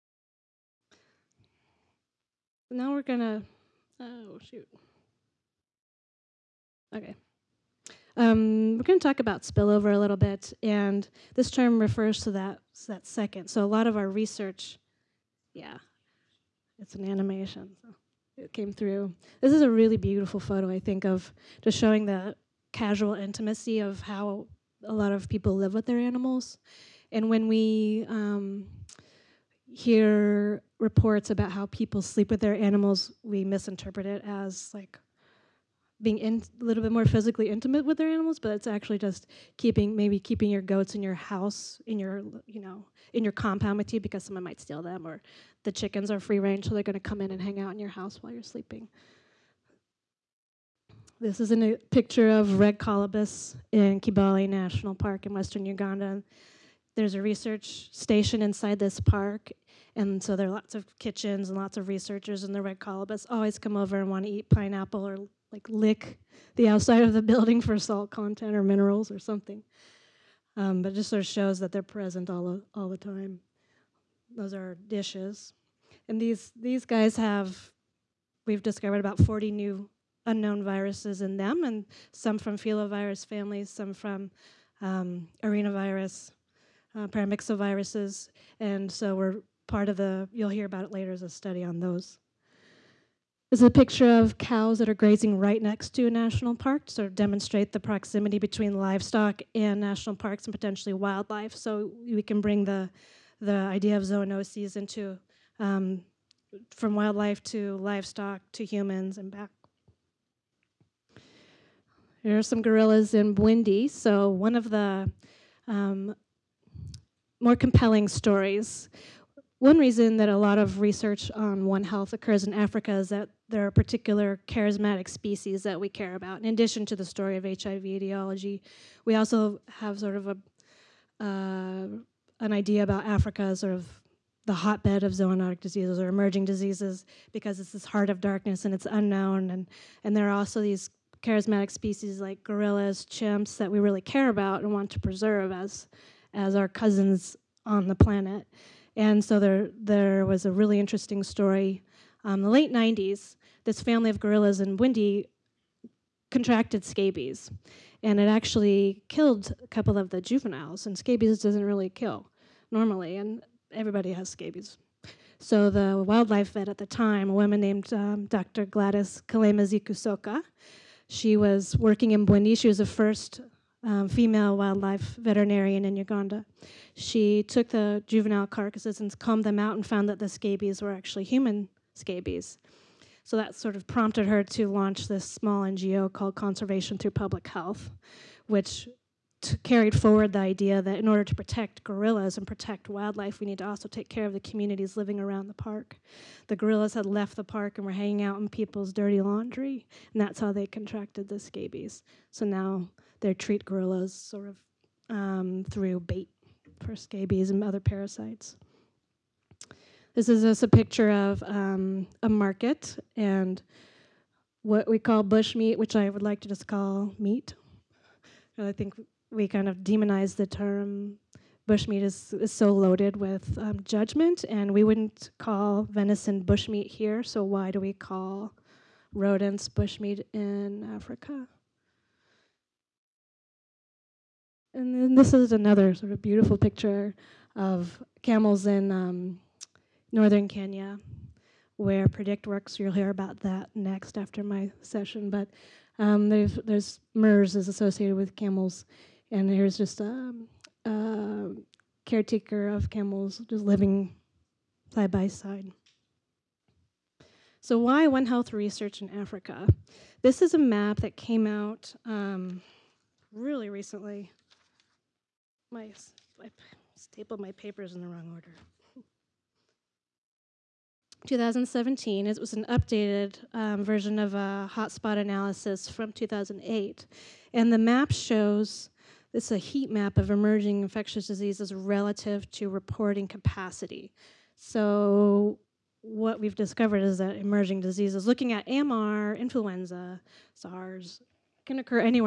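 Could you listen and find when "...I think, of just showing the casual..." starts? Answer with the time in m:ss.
0:20.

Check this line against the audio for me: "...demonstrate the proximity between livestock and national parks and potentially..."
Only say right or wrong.
right.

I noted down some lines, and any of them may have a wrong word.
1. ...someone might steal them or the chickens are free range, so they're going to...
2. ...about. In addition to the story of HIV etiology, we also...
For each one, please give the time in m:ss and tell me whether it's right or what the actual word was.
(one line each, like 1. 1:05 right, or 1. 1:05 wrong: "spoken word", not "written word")
1. 0:44 right
2. 2:06 right.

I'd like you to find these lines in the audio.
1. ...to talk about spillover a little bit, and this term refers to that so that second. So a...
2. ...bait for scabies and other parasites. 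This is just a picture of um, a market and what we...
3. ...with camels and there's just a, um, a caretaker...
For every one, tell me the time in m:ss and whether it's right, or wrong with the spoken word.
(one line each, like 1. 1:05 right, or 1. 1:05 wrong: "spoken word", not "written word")
1. 0:08 right
2. 3:26 right
3. 4:08 right.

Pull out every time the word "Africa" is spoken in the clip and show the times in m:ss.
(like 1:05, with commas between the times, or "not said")
2:02, 2:13, 3:50, 4:19.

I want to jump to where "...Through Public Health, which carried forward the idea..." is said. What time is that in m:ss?
3:06.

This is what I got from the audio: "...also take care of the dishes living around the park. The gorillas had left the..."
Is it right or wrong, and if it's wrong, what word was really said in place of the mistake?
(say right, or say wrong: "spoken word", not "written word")
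wrong: "communities", not "dishes".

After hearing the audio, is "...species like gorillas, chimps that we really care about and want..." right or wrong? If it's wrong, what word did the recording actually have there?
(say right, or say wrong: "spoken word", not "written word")
right.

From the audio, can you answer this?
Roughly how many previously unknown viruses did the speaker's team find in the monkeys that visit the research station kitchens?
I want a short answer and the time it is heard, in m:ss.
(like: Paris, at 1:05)
40, at 1:19.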